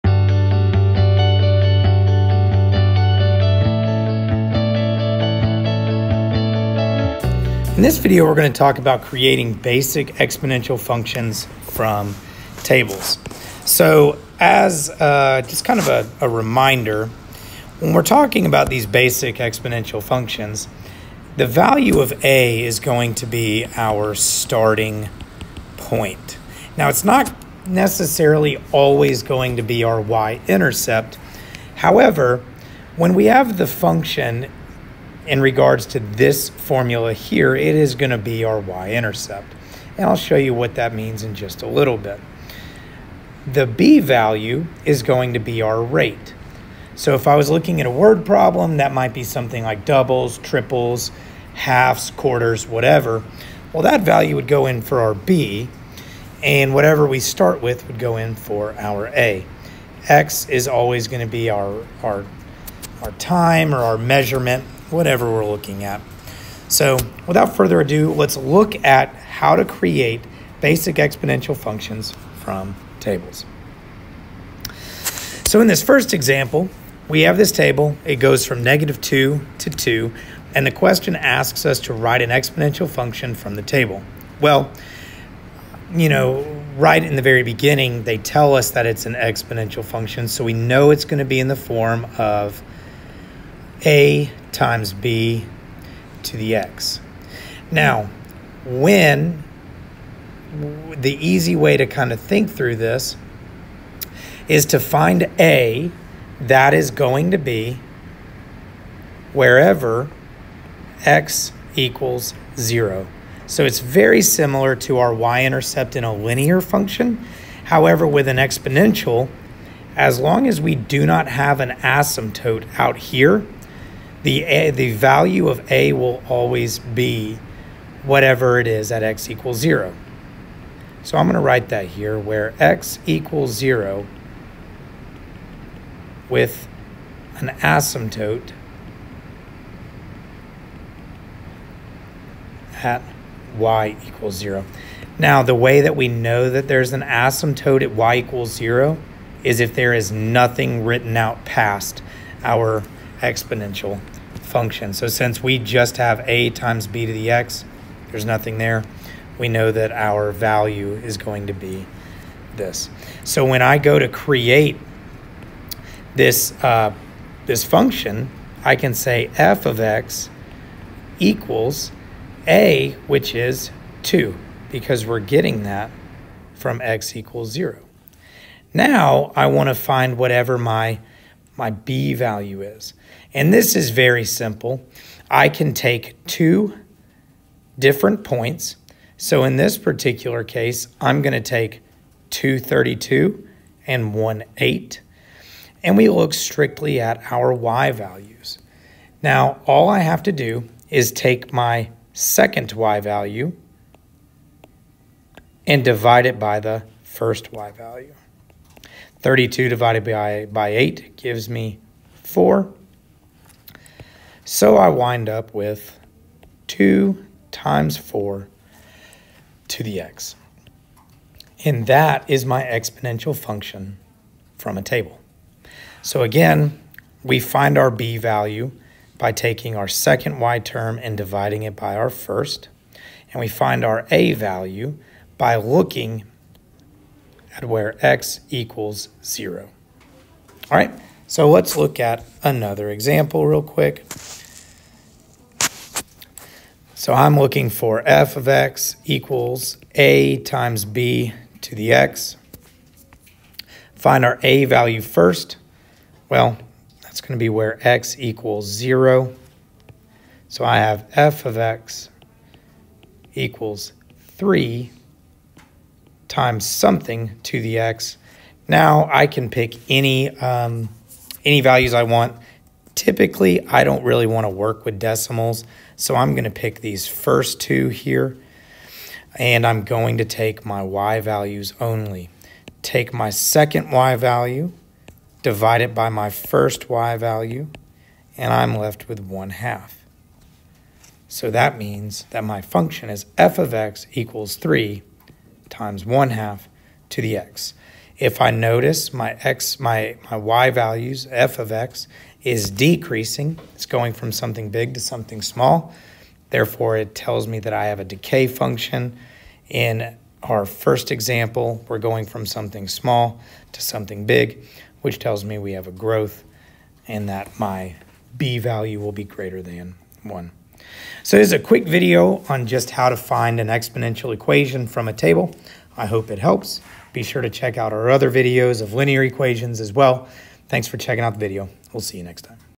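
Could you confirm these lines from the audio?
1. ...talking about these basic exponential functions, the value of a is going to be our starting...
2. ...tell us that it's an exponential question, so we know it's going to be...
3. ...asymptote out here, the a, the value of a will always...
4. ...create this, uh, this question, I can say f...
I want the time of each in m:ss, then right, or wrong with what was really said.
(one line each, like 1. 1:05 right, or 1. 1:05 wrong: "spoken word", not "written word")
1. 0:18 right
2. 1:28 wrong: "function", not "question"
3. 2:01 right
4. 2:44 wrong: "function", not "question".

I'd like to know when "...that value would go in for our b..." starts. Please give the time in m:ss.
0:53.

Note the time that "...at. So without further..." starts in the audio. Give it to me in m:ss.
1:05.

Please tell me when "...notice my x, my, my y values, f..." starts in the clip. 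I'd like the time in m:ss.
4:58.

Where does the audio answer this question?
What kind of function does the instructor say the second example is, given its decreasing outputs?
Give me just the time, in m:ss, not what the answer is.
5:08.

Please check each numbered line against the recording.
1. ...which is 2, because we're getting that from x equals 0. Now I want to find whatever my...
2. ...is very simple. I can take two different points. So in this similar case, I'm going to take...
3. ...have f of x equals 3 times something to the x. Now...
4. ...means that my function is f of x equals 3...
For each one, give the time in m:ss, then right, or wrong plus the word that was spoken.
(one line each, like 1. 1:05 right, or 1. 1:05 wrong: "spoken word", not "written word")
1. 2:53 right
2. 3:03 wrong: "particular", not "similar"
3. 4:20 right
4. 4:51 right.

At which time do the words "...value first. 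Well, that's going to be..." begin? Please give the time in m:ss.
4:14.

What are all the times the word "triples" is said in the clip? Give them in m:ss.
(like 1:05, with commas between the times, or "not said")
0:50.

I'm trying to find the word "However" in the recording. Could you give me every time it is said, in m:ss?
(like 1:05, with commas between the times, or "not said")
0:31, 1:57.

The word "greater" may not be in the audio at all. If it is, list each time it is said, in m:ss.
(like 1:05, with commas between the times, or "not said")
5:19.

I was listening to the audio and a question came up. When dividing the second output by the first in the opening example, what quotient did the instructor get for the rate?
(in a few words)
4.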